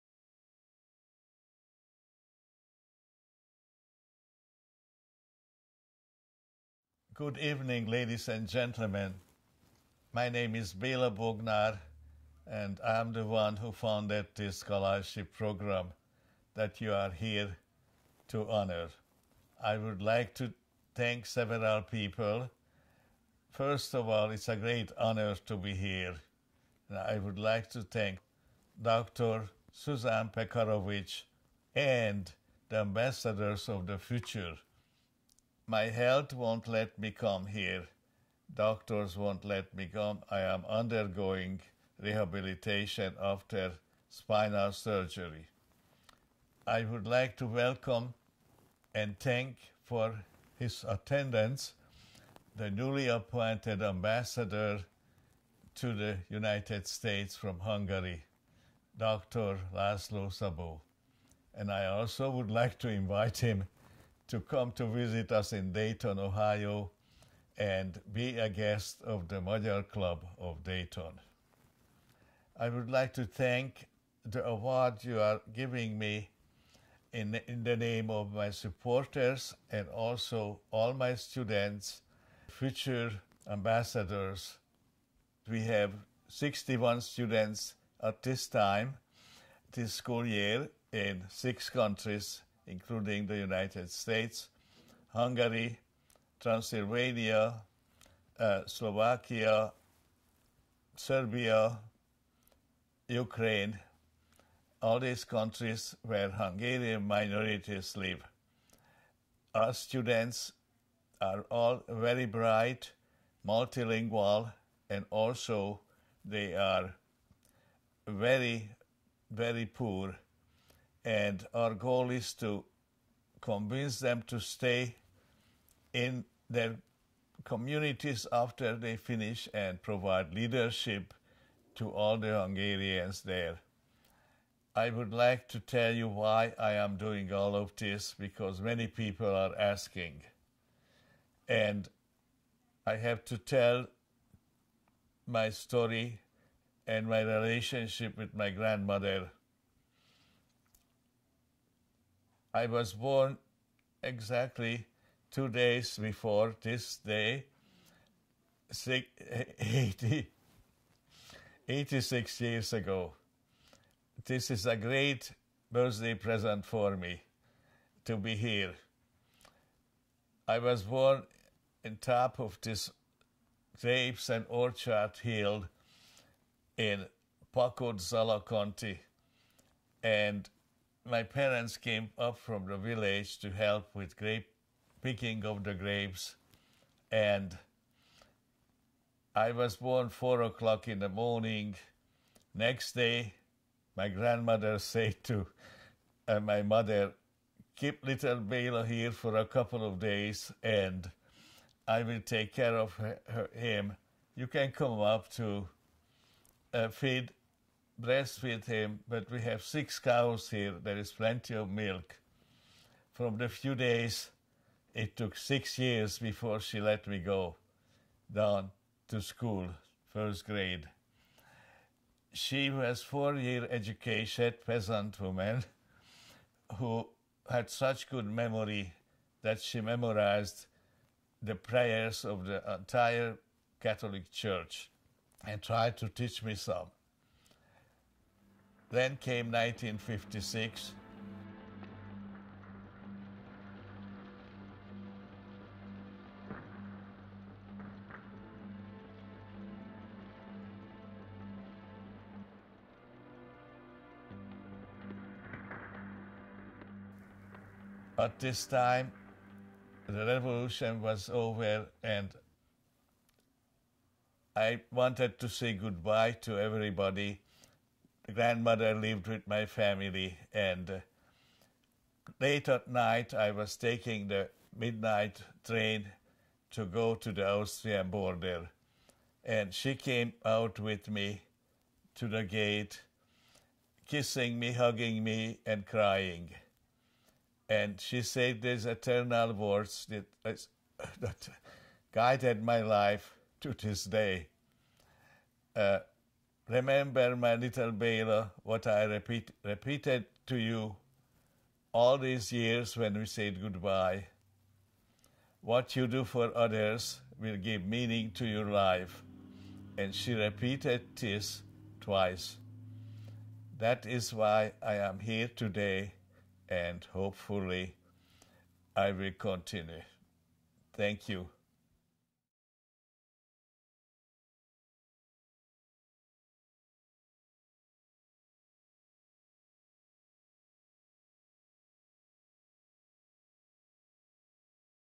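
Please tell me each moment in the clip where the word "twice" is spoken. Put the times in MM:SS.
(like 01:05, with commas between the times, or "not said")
05:11.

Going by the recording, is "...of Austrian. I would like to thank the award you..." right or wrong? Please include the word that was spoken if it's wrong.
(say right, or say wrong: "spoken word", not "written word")
wrong: "Dayton", not "Austrian".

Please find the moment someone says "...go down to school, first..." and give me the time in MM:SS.
03:37.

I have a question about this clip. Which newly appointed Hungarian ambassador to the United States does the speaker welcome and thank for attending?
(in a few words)
Laszlo Szabo.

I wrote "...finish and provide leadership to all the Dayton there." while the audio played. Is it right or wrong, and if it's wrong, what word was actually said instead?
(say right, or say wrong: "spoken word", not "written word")
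wrong: "Hungarians", not "Dayton".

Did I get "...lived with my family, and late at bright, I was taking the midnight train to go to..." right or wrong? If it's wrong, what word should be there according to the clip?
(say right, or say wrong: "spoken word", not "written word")
wrong: "night", not "bright".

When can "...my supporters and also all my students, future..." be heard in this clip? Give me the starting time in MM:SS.
01:18.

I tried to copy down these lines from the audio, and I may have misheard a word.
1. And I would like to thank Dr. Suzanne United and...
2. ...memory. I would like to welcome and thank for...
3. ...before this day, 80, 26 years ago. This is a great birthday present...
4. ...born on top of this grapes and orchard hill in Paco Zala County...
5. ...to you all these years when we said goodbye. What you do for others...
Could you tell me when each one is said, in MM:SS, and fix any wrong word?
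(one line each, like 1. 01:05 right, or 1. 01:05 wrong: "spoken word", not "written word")
1. 00:26 wrong: "Pekarovic", not "United"
2. 00:44 wrong: "surgery", not "memory"
3. 02:35 wrong: "86", not "26"
4. 02:50 right
5. 05:00 right.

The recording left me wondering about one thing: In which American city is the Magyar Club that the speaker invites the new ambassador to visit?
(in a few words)
Dayton, Ohio.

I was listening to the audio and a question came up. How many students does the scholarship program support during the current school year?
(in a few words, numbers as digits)
61.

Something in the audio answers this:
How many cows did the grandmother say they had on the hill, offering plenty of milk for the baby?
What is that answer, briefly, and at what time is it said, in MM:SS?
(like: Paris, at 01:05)
6, at 03:29.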